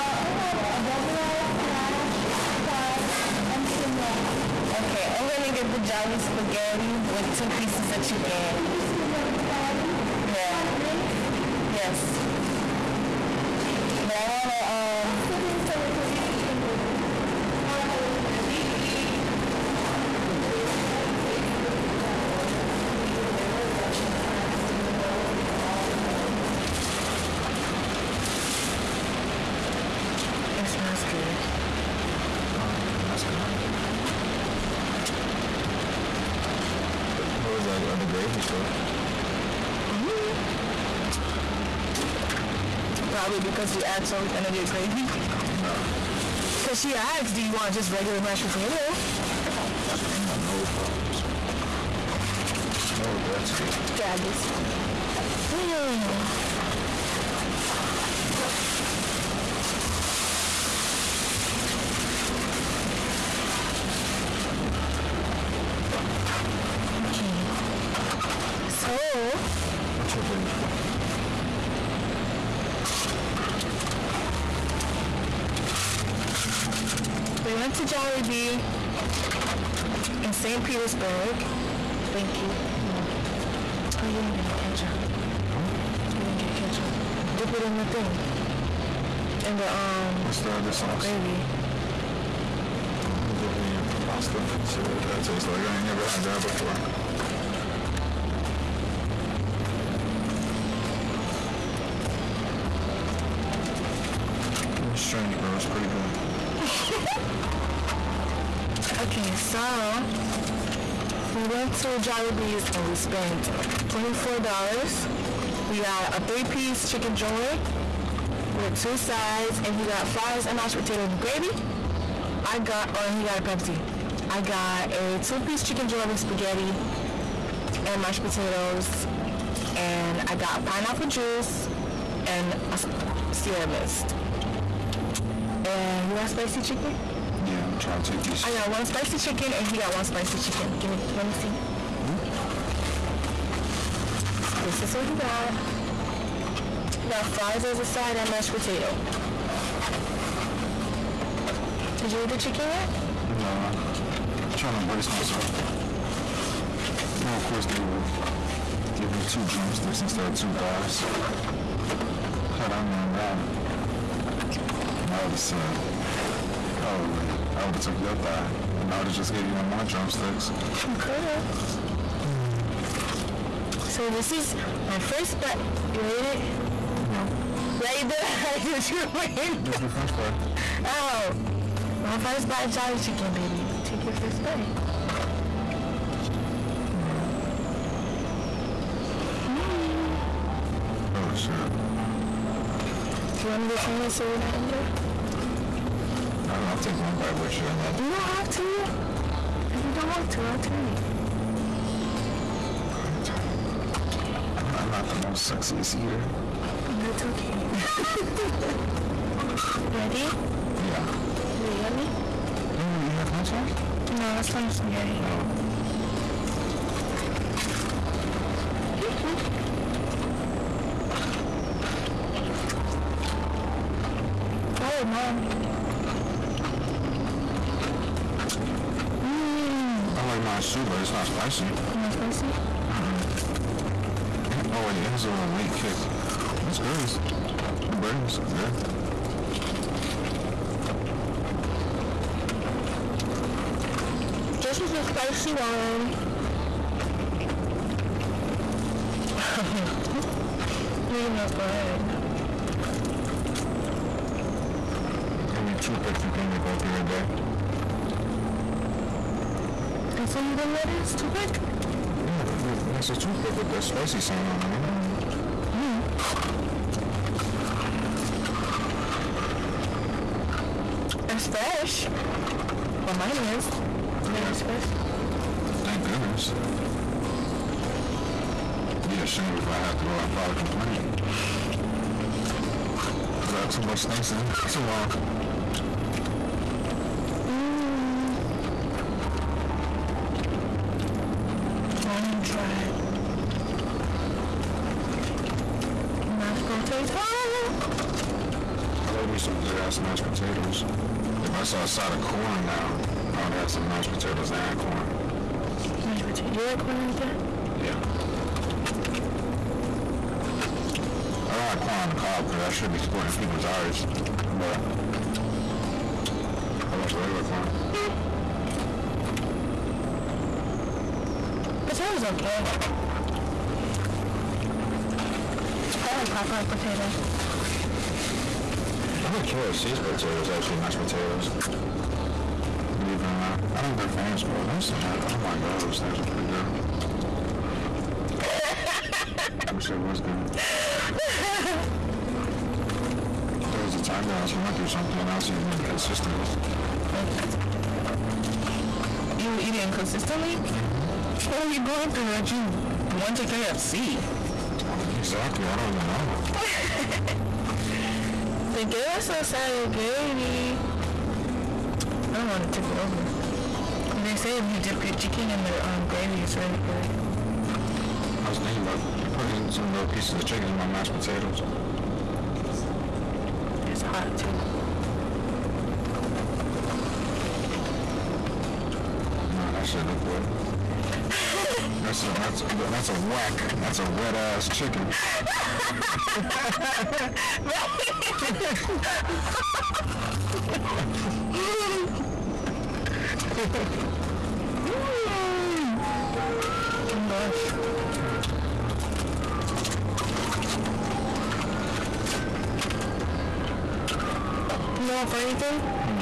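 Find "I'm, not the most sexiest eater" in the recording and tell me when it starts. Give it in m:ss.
3:24.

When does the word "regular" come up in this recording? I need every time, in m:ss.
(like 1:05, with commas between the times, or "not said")
0:47, 5:17.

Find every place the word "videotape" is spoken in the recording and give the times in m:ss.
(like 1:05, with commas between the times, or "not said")
not said.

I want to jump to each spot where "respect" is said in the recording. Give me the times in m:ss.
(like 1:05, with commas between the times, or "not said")
not said.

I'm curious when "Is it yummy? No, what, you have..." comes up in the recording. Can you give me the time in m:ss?
3:31.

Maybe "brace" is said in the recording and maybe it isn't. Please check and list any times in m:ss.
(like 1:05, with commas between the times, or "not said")
2:34.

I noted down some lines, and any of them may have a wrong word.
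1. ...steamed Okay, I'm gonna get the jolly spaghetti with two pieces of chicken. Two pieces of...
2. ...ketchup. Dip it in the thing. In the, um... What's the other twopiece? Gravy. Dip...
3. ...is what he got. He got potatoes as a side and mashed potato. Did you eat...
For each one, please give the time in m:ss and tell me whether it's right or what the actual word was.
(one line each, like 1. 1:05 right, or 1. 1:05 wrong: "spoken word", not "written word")
1. 0:03 right
2. 1:26 wrong: "sauce", not "twopiece"
3. 2:24 wrong: "fries", not "potatoes".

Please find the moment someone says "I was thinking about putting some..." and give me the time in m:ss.
6:08.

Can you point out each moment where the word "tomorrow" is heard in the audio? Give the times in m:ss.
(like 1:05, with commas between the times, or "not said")
4:44.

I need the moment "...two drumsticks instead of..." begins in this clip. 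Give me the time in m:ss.
2:39.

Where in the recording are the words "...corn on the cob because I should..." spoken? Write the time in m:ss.
5:11.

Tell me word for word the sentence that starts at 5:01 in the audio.
If I saw a side of corn now, I would have some mashed potatoes and corn.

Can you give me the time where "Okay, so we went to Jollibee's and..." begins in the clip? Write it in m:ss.
1:49.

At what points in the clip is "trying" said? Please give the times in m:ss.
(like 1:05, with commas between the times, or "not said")
2:17, 2:34.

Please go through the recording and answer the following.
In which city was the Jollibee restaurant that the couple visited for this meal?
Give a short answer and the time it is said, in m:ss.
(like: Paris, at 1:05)
St. Petersburg, at 1:20.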